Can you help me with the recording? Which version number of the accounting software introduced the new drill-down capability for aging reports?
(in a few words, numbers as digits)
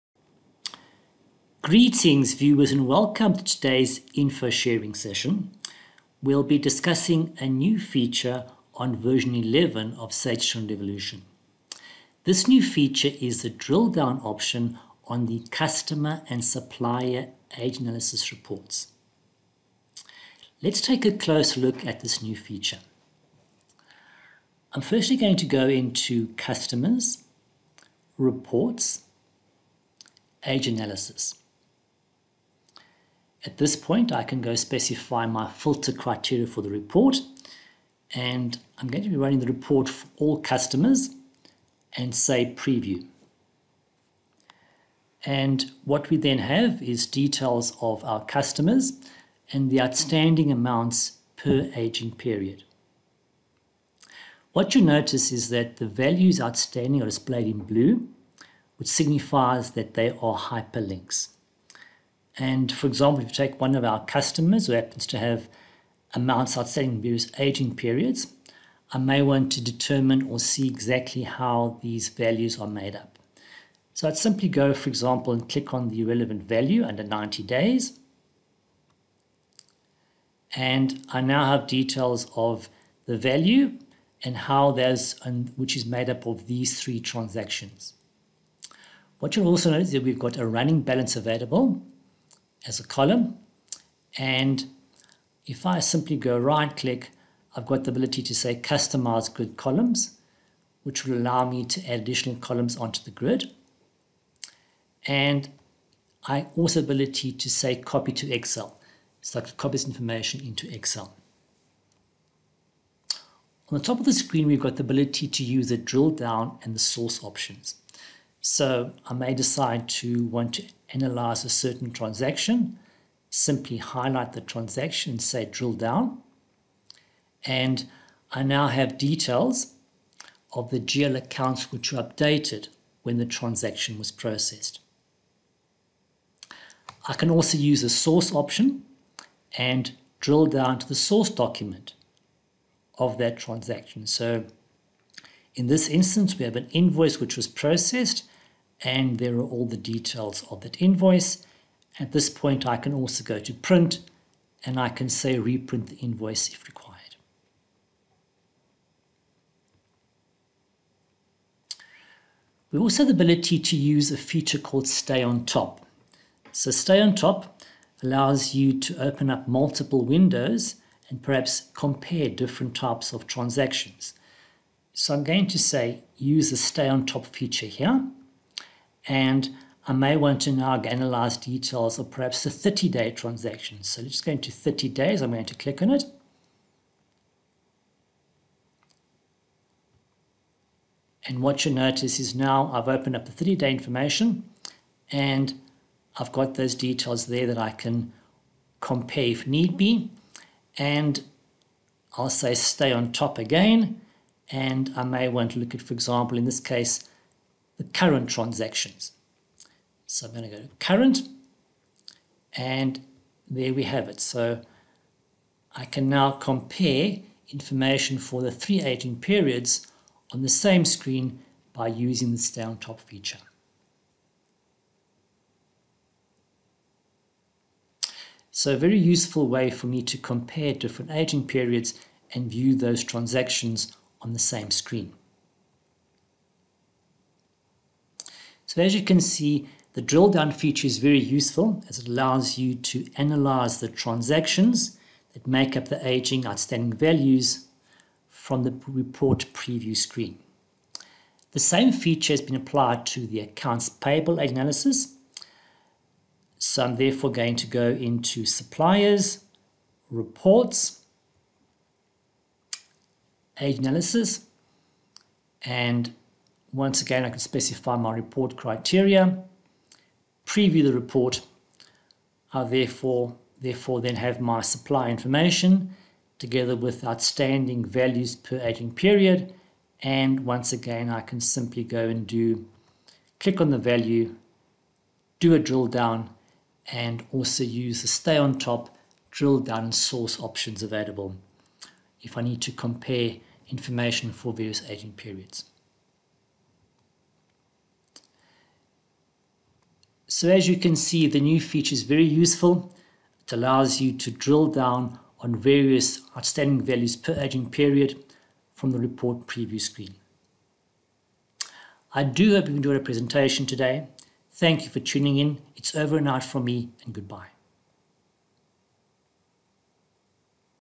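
11.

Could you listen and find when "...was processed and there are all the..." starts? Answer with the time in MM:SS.
02:27.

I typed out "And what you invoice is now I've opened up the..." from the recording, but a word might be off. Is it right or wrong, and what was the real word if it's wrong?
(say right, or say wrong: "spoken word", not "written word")
wrong: "notice", not "invoice".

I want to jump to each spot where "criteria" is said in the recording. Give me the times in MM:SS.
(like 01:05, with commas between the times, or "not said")
00:35, 04:28.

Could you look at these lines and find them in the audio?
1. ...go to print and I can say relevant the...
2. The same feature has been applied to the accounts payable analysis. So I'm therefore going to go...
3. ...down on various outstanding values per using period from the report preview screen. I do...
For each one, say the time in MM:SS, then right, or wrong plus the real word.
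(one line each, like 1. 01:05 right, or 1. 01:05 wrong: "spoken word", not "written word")
1. 02:33 wrong: "reprint", not "relevant"
2. 04:11 right
3. 05:04 wrong: "aging", not "using".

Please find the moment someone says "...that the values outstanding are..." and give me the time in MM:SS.
00:55.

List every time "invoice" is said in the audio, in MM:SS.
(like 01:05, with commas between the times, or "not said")
02:26, 02:30, 02:35.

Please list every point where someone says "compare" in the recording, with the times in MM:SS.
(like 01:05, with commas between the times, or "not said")
02:51, 03:18, 03:36, 03:50, 04:52.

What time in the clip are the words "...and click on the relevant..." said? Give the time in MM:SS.
01:15.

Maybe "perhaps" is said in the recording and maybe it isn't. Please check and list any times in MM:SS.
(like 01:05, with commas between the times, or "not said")
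02:51, 03:02.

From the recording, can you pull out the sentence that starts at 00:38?
And I'm going to be running the report for all customers and say preview.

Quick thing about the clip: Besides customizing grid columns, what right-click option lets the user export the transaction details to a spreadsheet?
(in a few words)
Copy to Excel.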